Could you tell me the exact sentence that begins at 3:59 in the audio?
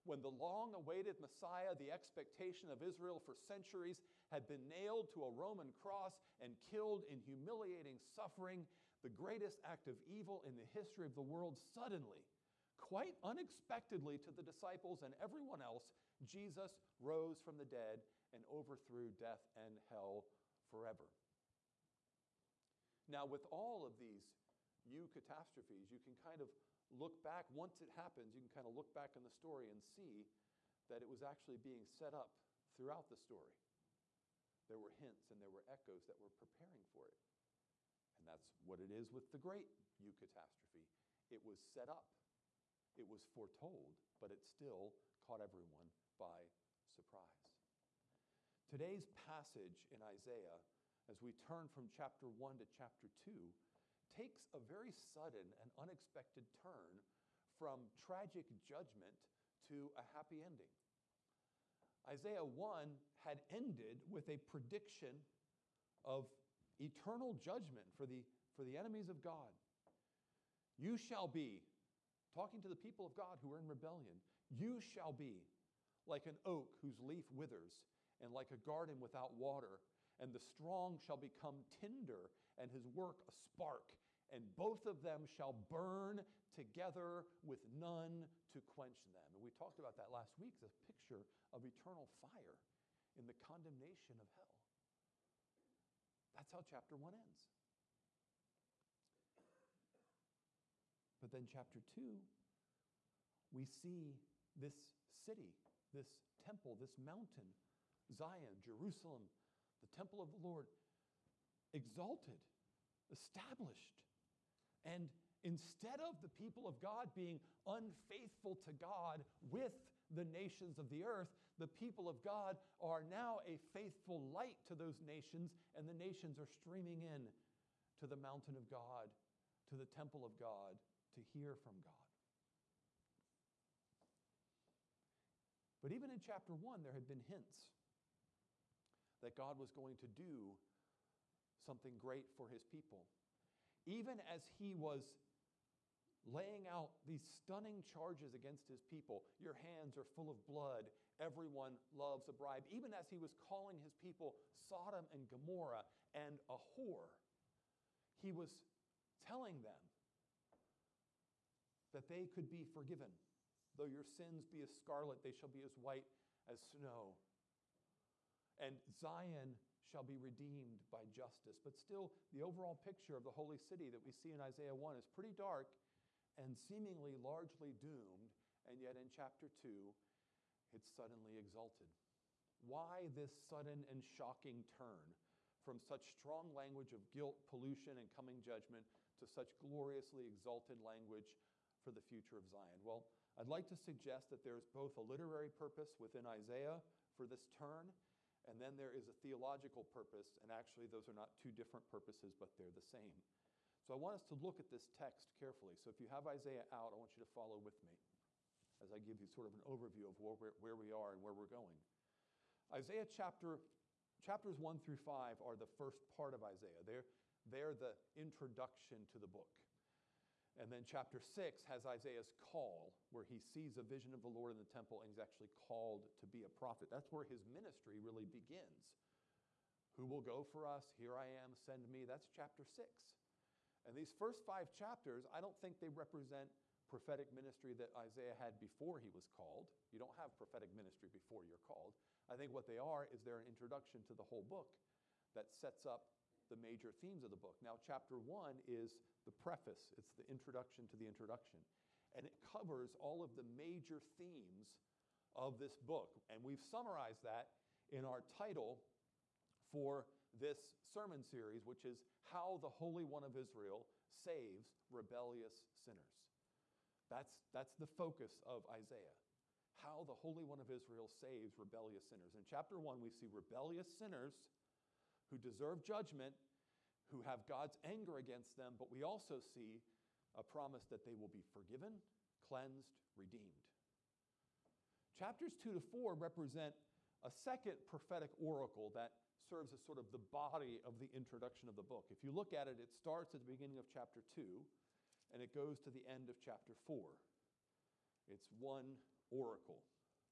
You don't have prophetic ministry before you're called.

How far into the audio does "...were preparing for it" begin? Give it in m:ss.
0:36.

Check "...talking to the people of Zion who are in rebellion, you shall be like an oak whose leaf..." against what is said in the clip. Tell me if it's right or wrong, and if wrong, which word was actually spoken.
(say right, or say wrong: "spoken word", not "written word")
wrong: "God", not "Zion".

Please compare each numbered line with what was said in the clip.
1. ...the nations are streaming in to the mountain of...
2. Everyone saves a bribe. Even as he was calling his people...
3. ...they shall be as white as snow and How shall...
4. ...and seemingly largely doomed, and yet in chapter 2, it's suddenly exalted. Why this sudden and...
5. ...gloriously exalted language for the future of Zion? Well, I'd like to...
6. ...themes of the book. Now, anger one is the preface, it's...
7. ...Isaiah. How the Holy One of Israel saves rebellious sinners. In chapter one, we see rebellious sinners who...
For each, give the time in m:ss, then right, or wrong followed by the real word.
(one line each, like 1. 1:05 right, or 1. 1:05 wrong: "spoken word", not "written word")
1. 2:05 right
2. 2:31 wrong: "loves", not "saves"
3. 2:45 wrong: "Zion", not "How"
4. 2:56 right
5. 3:09 right
6. 4:06 wrong: "chapter", not "anger"
7. 4:28 right.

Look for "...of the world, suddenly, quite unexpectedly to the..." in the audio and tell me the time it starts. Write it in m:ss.
0:11.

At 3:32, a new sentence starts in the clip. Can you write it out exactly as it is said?
Isaiah chapter, chapters 1 through 5 are the first part of Isaiah.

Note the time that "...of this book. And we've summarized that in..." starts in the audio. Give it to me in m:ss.
4:15.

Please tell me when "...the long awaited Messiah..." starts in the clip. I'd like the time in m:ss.
0:00.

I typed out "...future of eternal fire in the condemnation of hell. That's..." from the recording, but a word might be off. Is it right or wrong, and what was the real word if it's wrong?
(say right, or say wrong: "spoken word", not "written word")
wrong: "picture", not "future".